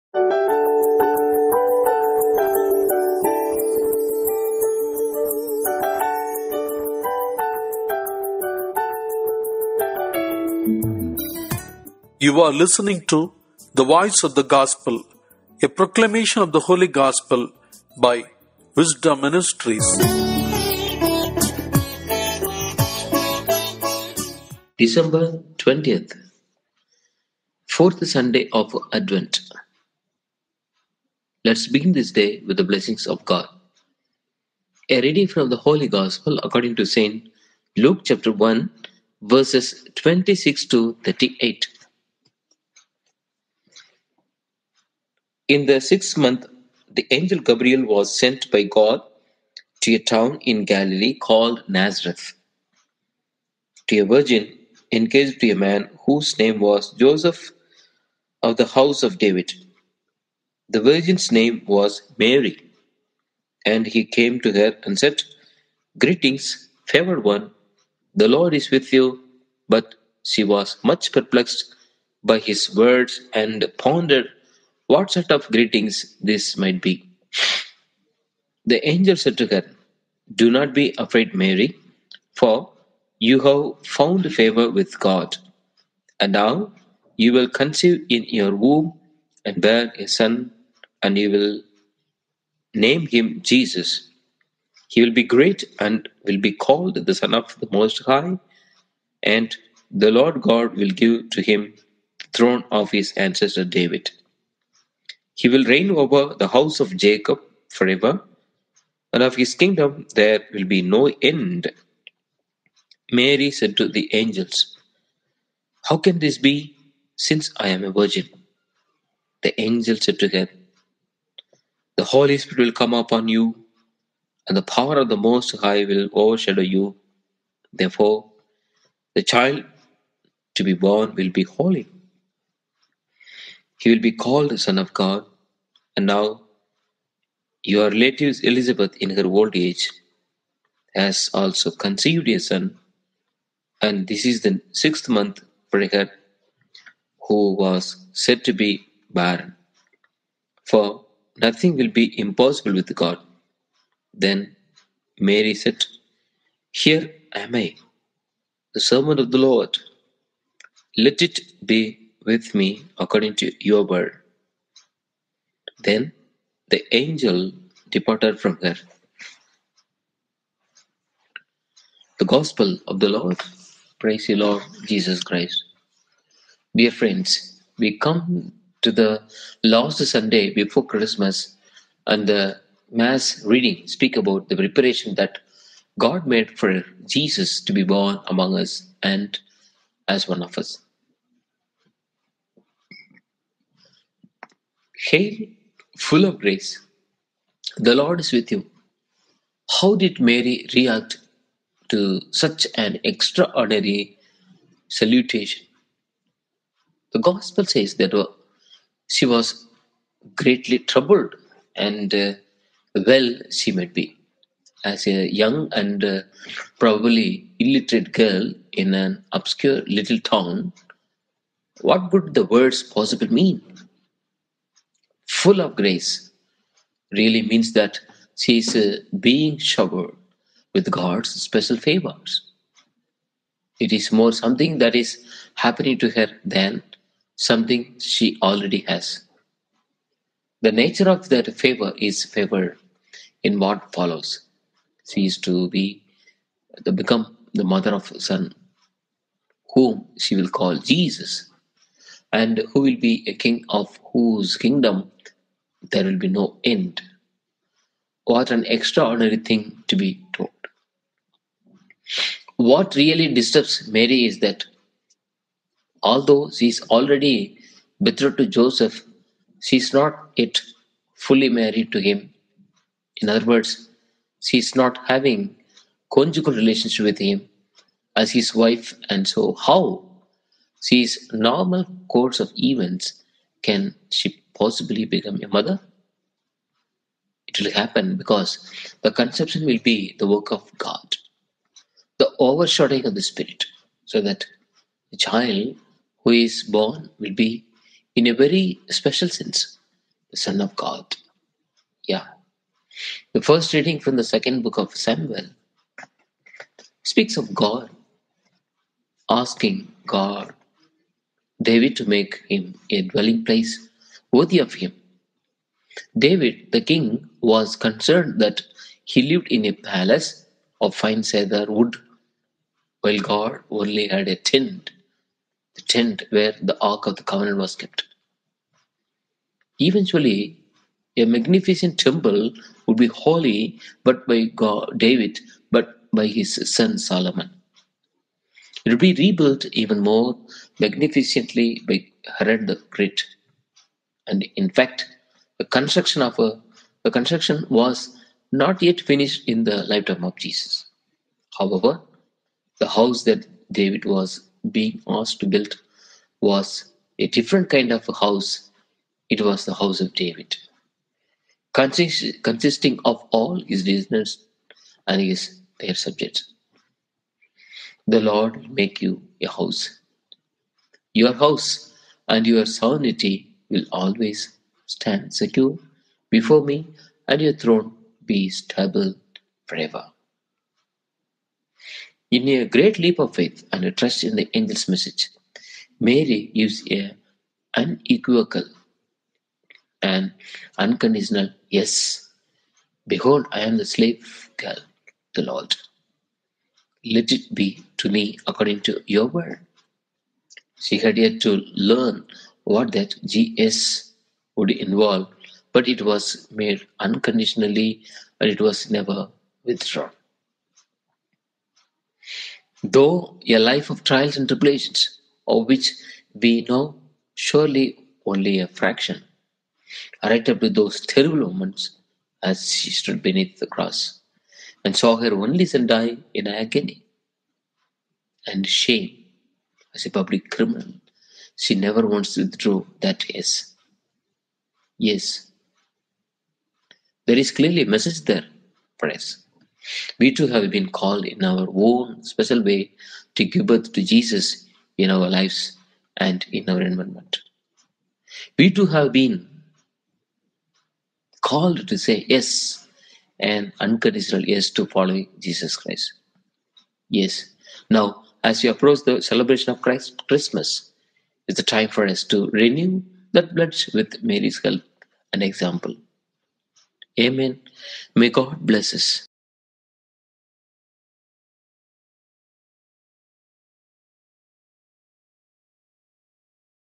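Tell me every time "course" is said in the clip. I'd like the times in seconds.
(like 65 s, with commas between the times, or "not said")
282 s.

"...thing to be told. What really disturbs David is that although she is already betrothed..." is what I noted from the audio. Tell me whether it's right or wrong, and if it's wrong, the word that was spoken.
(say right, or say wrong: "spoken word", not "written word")
wrong: "Mary", not "David".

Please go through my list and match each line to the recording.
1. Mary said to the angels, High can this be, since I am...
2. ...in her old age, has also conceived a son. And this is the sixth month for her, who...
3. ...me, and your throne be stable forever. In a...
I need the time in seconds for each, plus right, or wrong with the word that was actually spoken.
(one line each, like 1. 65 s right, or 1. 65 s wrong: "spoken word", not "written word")
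1. 113 s wrong: "How", not "High"
2. 138 s right
3. 376 s right.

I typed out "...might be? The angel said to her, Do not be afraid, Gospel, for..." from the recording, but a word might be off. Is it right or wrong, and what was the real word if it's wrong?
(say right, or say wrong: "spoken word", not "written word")
wrong: "Mary", not "Gospel".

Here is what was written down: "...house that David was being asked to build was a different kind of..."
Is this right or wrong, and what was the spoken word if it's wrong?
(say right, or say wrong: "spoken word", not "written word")
right.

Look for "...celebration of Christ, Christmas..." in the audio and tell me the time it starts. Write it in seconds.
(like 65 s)
459 s.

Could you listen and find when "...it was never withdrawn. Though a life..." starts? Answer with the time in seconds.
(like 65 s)
408 s.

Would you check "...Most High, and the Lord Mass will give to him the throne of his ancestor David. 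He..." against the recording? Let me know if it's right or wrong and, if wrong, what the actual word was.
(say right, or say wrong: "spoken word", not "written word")
wrong: "God", not "Mass".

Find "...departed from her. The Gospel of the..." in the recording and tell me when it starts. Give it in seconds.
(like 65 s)
167 s.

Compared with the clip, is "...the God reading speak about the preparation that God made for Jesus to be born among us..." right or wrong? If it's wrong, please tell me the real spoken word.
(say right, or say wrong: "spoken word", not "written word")
wrong: "Mass", not "God".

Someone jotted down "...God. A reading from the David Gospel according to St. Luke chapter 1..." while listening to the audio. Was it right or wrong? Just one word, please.
wrong.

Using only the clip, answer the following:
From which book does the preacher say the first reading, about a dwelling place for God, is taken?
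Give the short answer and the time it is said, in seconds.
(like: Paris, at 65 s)
Second book of Samuel, at 304 s.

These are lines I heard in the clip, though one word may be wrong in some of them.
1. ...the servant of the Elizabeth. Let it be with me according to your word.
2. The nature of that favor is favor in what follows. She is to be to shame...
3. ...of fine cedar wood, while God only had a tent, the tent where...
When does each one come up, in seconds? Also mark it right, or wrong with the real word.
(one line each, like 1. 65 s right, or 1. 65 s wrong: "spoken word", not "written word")
1. 158 s wrong: "Lord", not "Elizabeth"
2. 240 s wrong: "become", not "shame"
3. 320 s right.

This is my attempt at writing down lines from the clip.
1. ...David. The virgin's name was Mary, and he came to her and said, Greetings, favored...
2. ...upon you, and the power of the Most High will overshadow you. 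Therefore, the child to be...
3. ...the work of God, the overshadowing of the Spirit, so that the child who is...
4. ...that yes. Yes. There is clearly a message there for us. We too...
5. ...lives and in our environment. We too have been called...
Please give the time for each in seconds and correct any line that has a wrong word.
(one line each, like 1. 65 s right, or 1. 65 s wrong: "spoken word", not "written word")
1. 59 s right
2. 122 s right
3. 290 s right
4. 433 s right
5. 445 s right.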